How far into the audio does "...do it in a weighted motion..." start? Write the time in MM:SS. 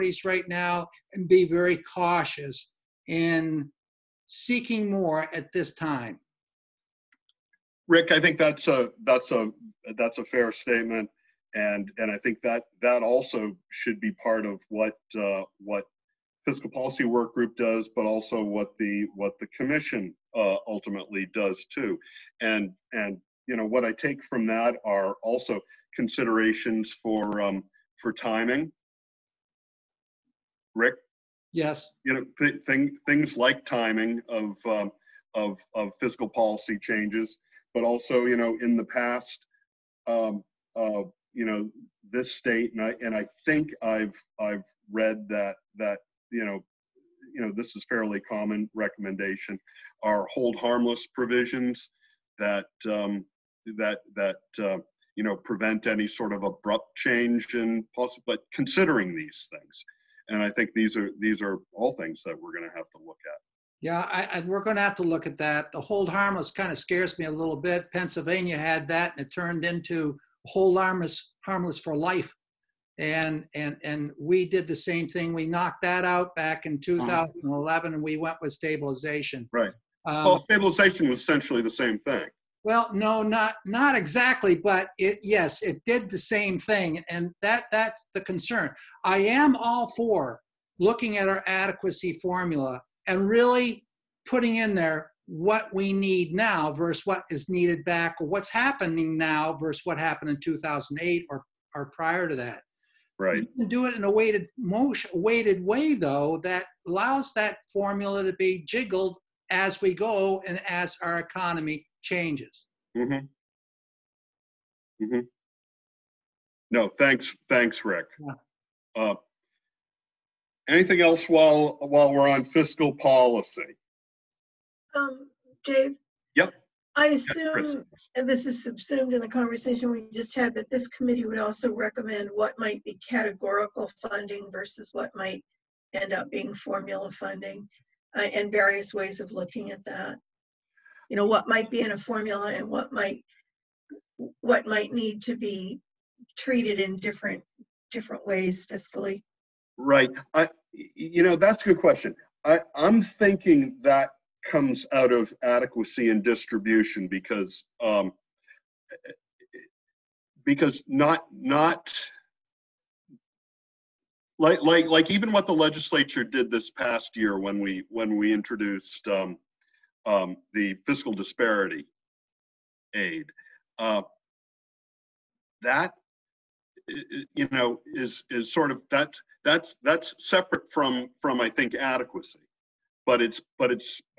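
01:43.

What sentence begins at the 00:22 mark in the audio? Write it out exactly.
And and you know what I take from that are also considerations for um, for timing.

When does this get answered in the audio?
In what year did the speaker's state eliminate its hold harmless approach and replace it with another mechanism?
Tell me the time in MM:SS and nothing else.
01:17.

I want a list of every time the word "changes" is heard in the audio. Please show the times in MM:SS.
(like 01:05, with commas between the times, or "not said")
00:36, 00:56, 01:52.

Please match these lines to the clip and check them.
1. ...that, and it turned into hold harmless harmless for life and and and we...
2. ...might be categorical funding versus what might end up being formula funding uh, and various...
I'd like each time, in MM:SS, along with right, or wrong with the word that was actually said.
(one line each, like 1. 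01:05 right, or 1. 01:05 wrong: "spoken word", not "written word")
1. 01:08 right
2. 02:12 right.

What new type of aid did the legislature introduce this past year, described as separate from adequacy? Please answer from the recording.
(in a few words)
fiscal disparity aid.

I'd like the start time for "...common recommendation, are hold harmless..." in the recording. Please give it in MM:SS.
00:48.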